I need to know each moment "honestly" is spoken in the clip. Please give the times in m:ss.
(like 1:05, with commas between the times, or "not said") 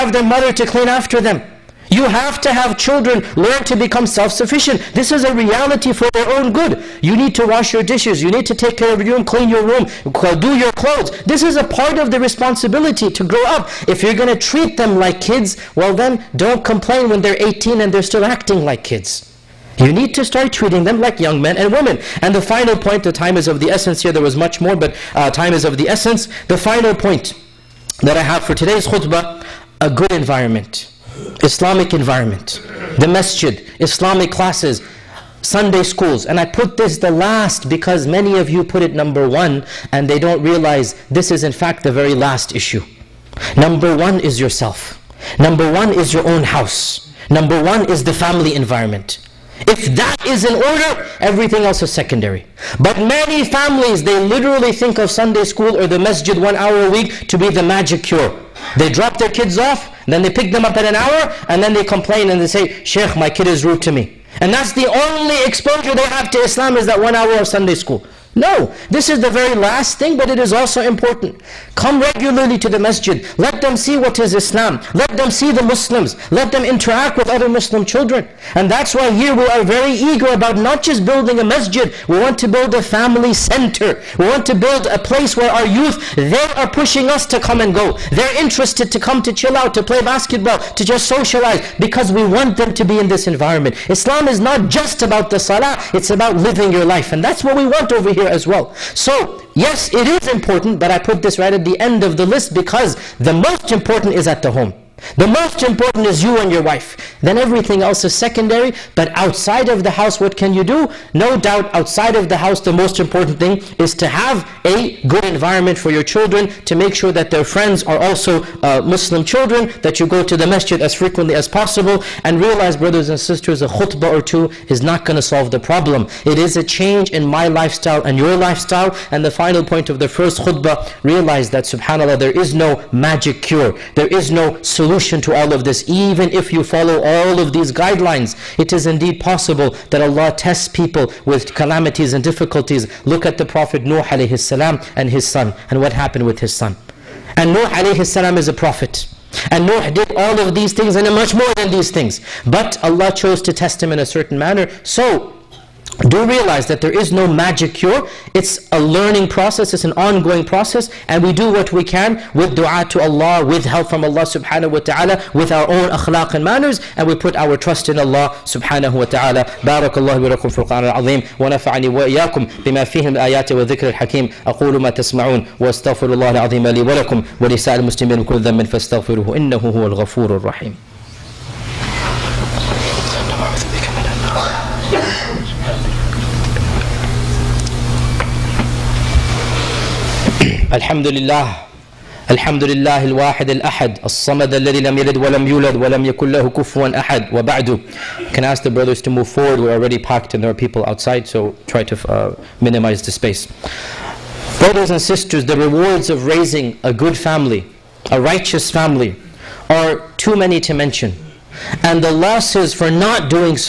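not said.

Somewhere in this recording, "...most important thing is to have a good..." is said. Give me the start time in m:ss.
1:52.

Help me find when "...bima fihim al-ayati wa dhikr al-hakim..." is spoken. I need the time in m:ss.
2:52.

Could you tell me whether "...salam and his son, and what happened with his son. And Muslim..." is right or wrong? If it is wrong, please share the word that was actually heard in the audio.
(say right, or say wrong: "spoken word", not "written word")
wrong: "Nuh", not "Muslim".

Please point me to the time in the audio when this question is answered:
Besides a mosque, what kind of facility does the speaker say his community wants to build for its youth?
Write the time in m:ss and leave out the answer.
1:22.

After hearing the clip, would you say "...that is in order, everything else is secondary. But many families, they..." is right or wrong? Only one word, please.
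right.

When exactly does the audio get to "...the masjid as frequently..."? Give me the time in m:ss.
2:00.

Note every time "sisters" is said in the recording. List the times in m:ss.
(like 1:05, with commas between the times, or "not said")
2:03, 3:25.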